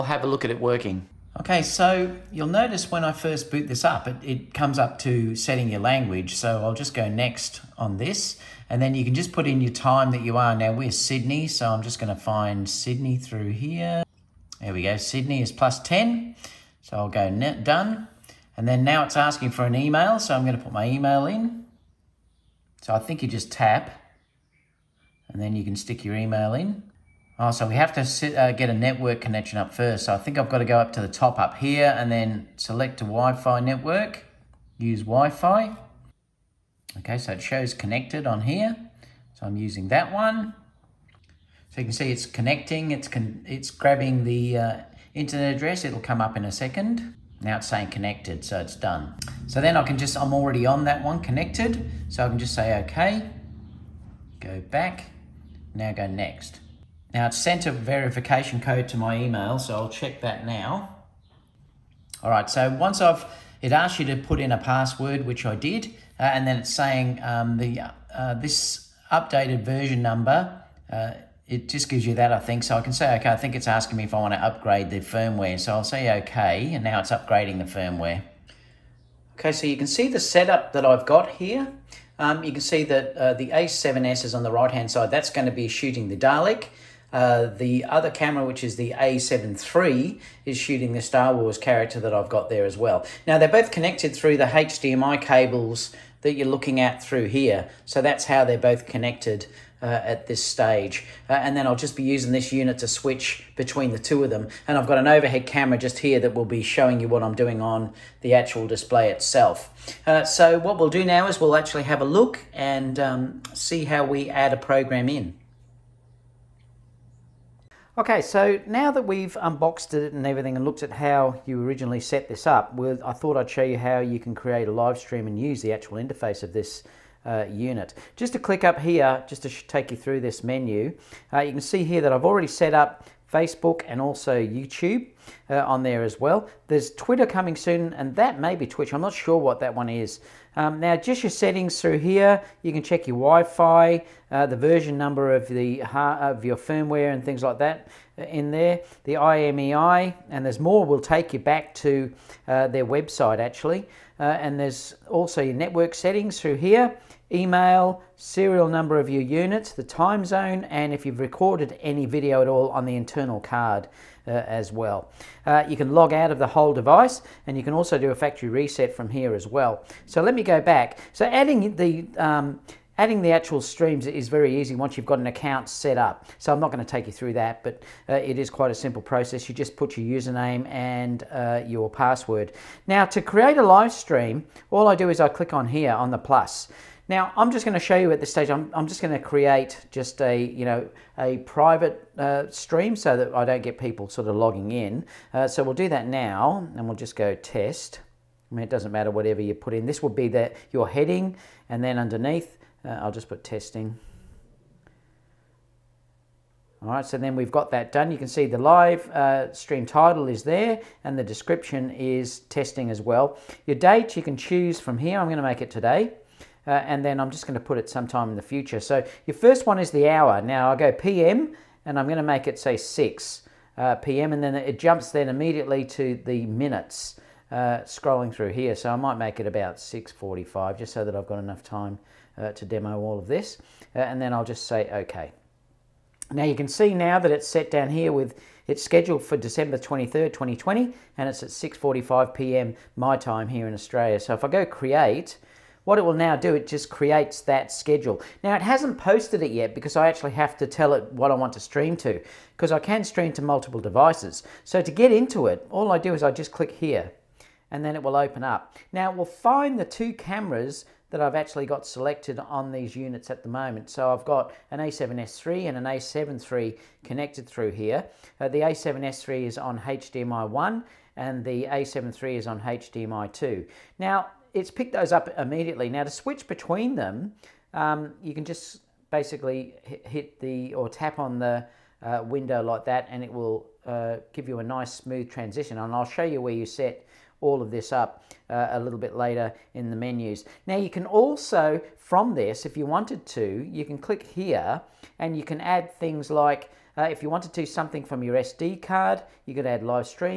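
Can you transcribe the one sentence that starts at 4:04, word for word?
So if I go create what it will now do, it just creates that schedule.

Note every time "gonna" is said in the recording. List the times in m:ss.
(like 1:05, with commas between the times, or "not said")
0:11, 0:20, 3:35.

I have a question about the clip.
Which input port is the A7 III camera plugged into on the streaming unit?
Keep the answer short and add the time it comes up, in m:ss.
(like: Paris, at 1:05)
HDMI 2, at 4:32.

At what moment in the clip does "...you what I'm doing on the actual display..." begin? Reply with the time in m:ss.
1:47.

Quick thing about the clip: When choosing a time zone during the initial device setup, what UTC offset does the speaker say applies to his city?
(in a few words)
plus 10.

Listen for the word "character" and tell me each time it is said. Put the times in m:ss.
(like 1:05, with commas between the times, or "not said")
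1:31.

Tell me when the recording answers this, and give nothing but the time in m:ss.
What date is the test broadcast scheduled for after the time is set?
3:59.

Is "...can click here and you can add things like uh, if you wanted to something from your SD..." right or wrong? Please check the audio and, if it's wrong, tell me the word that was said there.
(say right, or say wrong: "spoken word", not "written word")
right.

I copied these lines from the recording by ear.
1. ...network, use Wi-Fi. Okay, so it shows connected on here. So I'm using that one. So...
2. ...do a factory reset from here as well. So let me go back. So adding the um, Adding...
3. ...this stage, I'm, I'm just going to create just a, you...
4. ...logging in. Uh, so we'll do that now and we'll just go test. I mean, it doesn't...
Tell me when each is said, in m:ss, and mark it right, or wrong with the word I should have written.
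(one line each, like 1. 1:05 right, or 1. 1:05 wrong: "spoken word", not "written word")
1. 0:33 right
2. 2:47 right
3. 3:08 right
4. 3:14 right.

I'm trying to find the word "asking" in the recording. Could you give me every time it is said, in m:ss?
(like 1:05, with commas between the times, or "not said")
0:19, 1:13.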